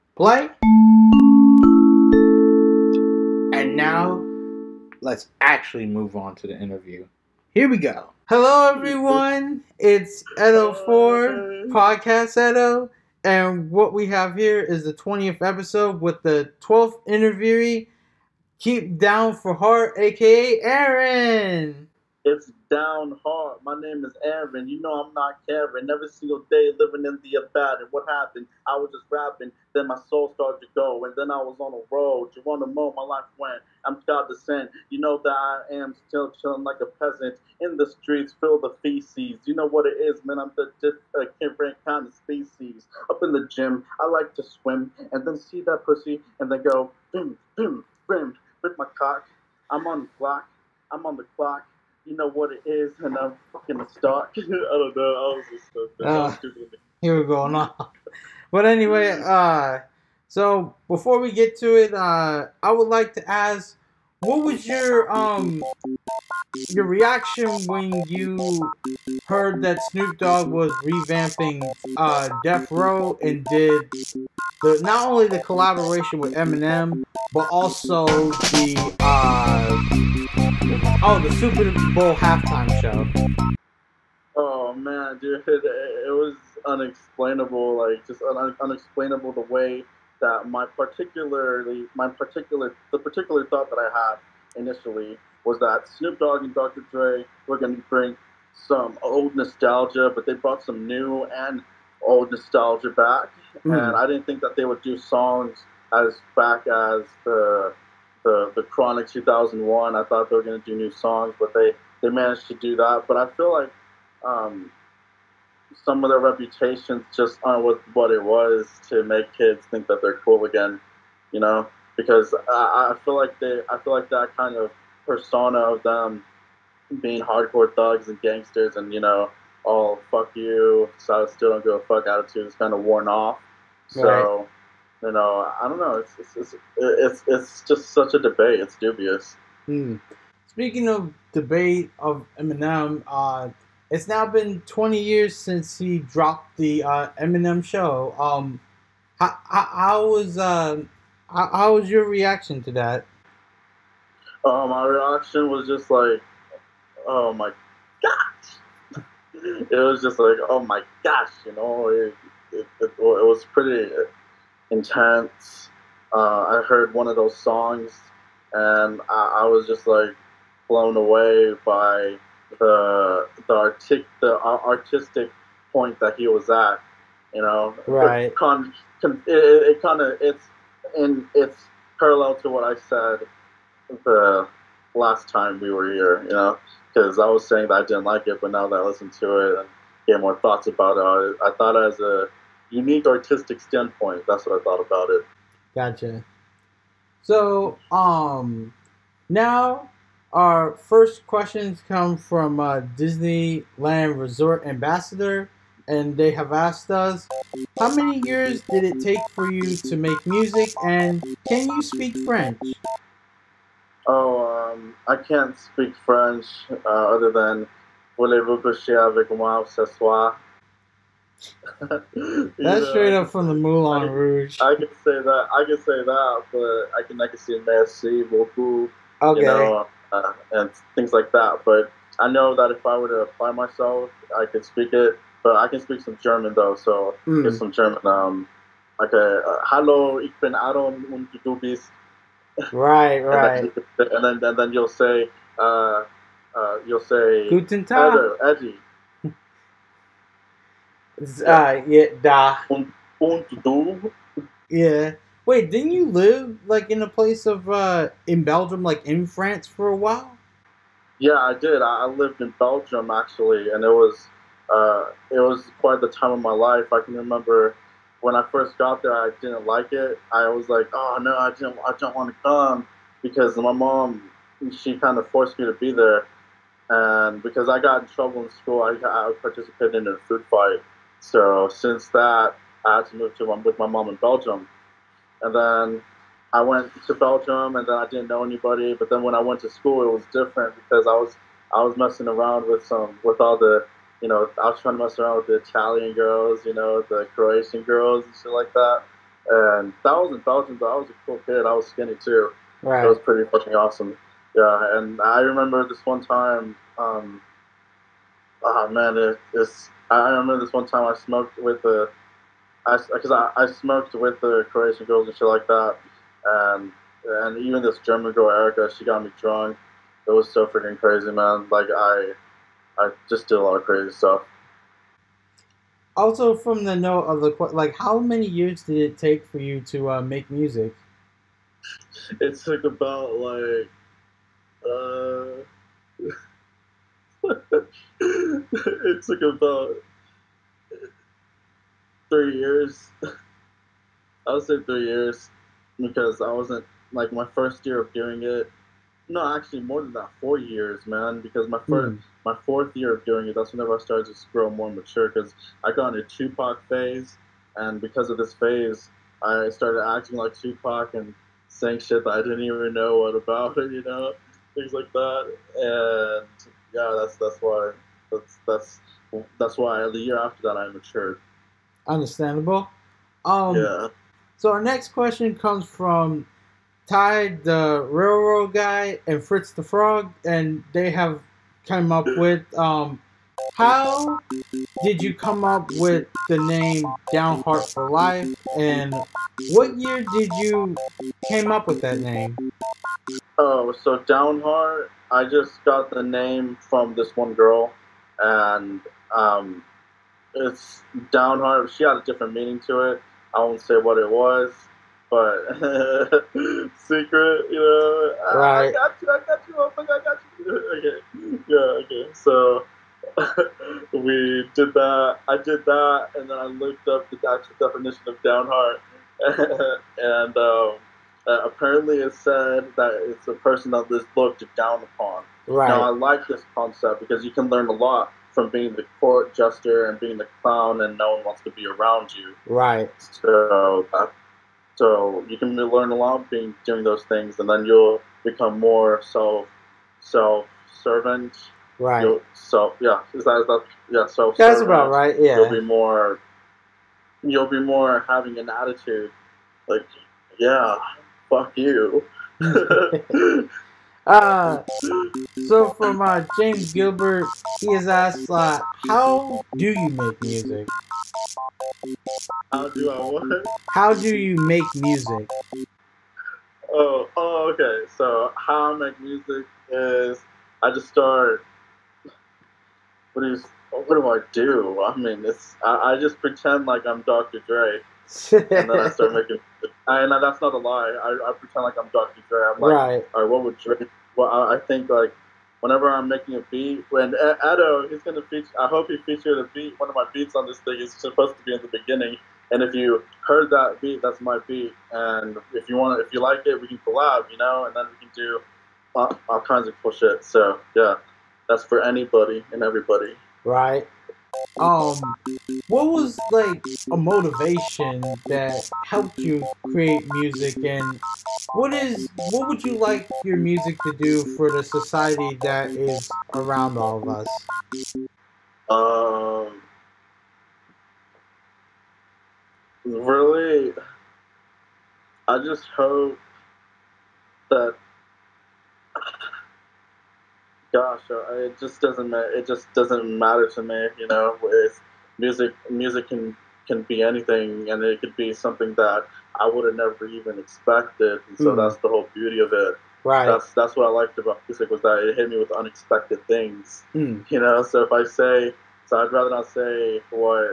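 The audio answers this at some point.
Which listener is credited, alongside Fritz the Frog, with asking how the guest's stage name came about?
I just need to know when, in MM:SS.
06:17.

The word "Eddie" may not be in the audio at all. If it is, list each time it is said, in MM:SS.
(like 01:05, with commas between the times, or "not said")
04:08.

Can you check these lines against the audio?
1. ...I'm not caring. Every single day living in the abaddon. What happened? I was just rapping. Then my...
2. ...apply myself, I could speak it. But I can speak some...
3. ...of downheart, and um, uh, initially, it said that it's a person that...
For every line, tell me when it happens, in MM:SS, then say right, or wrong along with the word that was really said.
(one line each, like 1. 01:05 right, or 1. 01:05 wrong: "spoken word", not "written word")
1. 00:25 right
2. 03:53 right
3. 06:58 wrong: "apparently", not "initially".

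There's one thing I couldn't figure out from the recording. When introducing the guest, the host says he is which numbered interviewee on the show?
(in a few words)
12th.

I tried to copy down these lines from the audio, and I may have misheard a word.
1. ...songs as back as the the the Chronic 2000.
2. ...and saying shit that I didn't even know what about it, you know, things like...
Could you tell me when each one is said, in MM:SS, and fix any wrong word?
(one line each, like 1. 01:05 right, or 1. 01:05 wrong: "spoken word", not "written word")
1. 01:44 wrong: "2001", not "2000"
2. 06:01 right.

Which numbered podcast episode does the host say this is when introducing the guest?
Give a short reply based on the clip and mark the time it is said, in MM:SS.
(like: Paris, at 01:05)
20th, at 00:14.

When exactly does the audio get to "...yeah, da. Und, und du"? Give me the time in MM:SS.
04:11.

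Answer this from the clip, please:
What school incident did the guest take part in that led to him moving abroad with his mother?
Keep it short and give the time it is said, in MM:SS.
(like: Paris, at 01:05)
A food fight, at 04:40.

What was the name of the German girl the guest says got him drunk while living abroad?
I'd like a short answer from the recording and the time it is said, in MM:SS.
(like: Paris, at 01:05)
Erica, at 05:18.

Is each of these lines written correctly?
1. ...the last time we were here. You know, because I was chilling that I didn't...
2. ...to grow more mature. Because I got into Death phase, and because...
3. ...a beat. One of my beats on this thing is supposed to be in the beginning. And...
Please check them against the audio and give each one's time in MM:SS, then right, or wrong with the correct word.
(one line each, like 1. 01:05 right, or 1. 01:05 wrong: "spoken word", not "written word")
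1. 03:04 wrong: "saying", not "chilling"
2. 05:54 wrong: "Tupac", not "Death"
3. 08:09 right.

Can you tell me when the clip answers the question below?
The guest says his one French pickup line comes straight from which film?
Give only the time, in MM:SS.
03:43.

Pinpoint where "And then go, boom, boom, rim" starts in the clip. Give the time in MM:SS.
00:46.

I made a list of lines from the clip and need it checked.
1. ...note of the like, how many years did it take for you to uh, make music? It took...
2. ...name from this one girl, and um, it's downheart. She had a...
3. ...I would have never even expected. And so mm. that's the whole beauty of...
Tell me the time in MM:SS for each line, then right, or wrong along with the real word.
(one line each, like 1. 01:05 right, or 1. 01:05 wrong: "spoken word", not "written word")
1. 05:26 right
2. 06:36 right
3. 08:59 right.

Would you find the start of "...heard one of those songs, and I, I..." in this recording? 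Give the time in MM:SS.
02:46.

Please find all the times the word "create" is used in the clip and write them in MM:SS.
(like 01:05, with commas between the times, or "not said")
08:29.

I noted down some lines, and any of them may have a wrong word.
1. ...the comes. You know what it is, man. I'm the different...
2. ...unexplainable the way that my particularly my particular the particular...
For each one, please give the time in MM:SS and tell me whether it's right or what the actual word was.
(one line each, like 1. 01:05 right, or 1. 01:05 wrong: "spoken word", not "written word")
1. 00:38 wrong: "feces", not "comes"
2. 01:28 right.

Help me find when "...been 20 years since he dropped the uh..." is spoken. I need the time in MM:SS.
02:24.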